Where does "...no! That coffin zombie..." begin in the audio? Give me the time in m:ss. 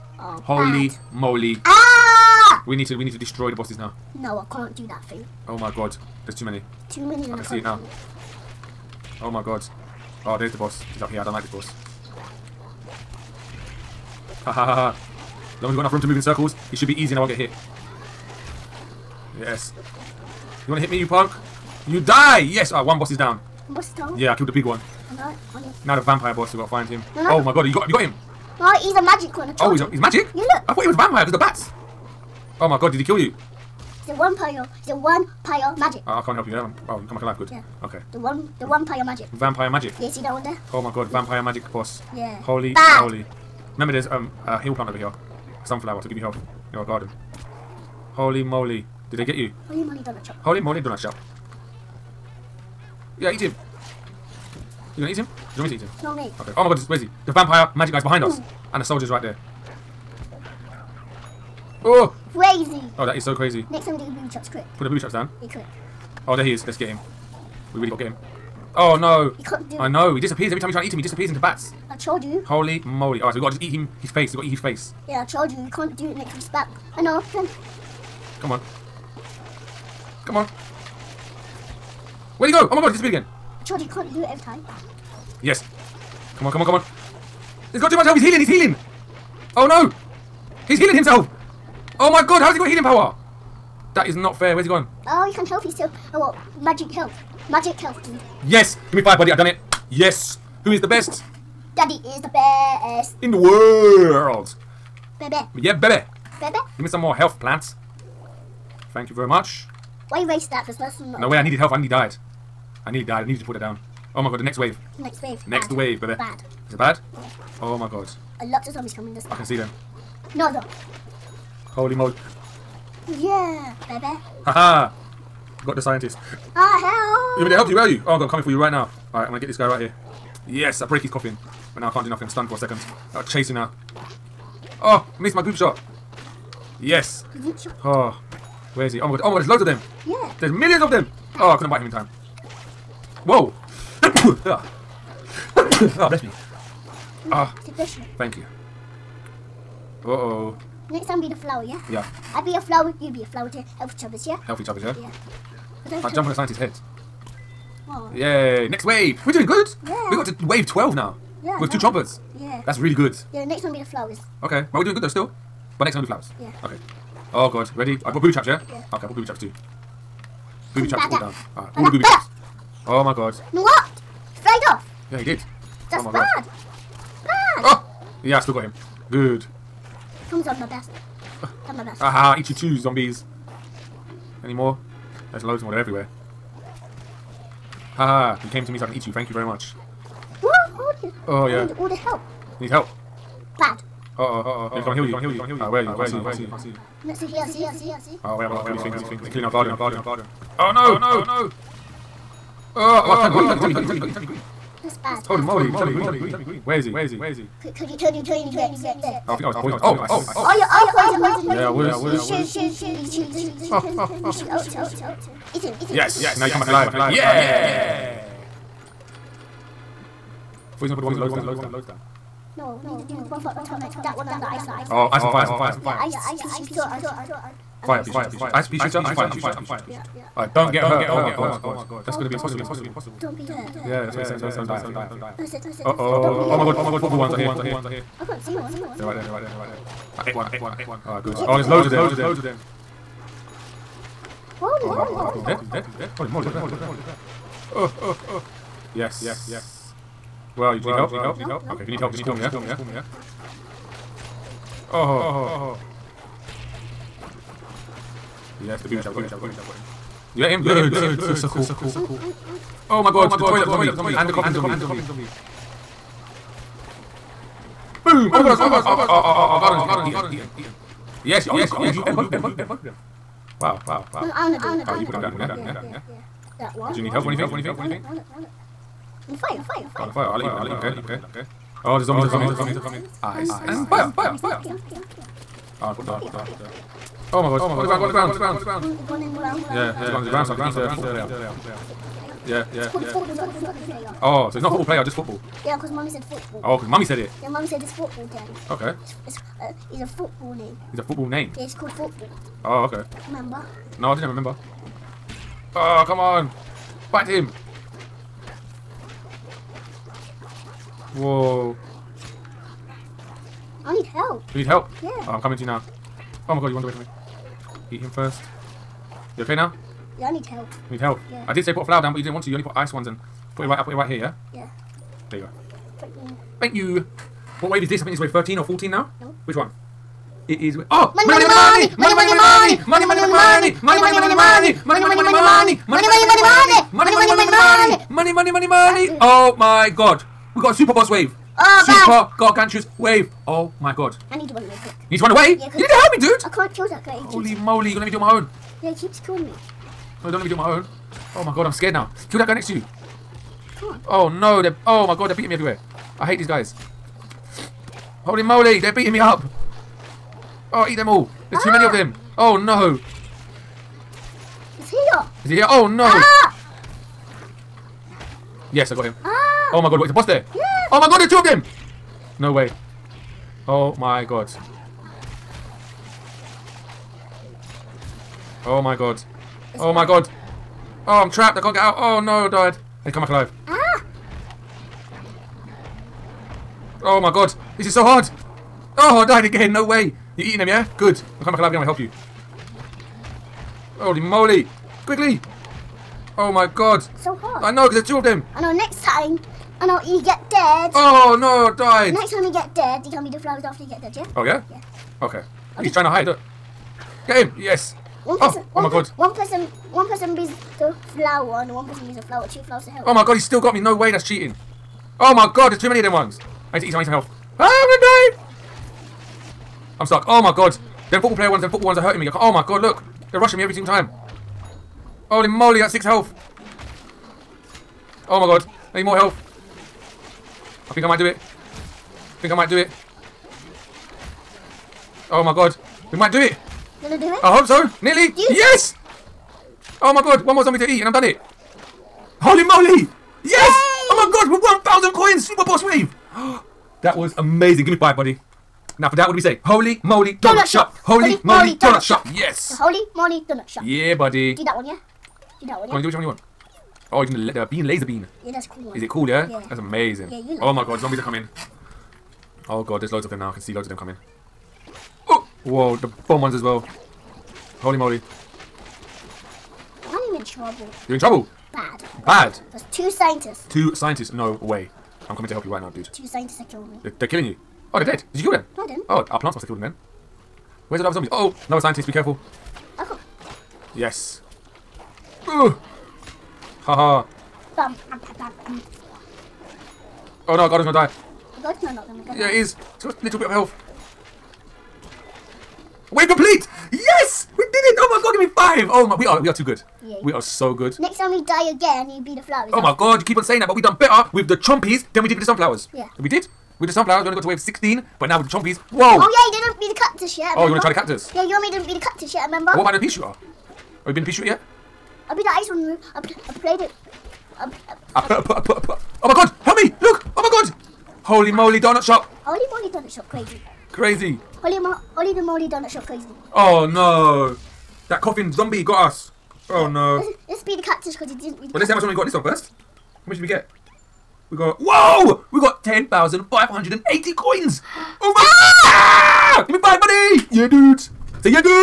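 8:46.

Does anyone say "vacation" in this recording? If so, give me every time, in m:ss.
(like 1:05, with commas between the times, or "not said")
not said.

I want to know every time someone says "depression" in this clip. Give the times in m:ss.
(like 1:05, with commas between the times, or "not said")
not said.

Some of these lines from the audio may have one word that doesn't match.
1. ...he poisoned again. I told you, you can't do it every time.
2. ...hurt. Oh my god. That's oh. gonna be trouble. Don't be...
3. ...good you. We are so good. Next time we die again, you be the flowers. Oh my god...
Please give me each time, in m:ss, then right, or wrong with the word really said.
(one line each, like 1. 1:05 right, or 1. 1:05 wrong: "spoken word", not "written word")
1. 1:22 wrong: "disappeared", not "poisoned"
2. 3:50 wrong: "impossible", not "trouble"
3. 8:19 right.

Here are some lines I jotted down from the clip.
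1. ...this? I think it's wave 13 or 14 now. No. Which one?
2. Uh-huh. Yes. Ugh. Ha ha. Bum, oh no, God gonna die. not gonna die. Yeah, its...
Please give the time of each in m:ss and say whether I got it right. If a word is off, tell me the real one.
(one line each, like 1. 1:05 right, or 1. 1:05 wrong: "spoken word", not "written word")
1. 5:27 right
2. 8:02 right.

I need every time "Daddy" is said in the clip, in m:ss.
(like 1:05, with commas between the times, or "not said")
1:41.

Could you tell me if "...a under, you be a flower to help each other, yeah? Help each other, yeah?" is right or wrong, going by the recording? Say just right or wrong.
wrong.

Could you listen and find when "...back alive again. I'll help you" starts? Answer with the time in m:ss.
6:31.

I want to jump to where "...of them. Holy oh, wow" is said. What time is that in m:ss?
4:01.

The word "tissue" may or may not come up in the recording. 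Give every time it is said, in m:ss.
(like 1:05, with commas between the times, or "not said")
not said.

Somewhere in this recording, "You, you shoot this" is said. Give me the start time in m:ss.
3:32.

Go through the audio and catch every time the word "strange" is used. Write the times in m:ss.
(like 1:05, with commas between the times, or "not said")
not said.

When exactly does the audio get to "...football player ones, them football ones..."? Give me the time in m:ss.
7:01.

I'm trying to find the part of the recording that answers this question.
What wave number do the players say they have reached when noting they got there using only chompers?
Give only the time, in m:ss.
2:40.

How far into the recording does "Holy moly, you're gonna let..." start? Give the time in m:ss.
5:47.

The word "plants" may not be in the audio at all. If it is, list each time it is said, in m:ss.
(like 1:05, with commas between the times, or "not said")
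0:44, 1:47, 7:59.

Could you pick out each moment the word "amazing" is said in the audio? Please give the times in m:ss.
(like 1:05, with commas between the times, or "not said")
7:27, 7:39.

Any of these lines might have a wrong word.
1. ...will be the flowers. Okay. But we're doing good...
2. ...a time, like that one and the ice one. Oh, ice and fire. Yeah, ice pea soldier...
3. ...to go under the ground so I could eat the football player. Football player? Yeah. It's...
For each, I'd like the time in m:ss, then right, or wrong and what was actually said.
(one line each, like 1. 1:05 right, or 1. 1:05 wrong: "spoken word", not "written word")
1. 2:43 right
2. 3:43 wrong: "shooter", not "soldier"
3. 4:50 right.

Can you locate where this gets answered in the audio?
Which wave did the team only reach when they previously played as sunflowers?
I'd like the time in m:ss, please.
8:27.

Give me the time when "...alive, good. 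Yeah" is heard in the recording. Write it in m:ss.
0:37.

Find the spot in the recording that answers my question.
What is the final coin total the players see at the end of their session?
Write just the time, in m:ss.
8:55.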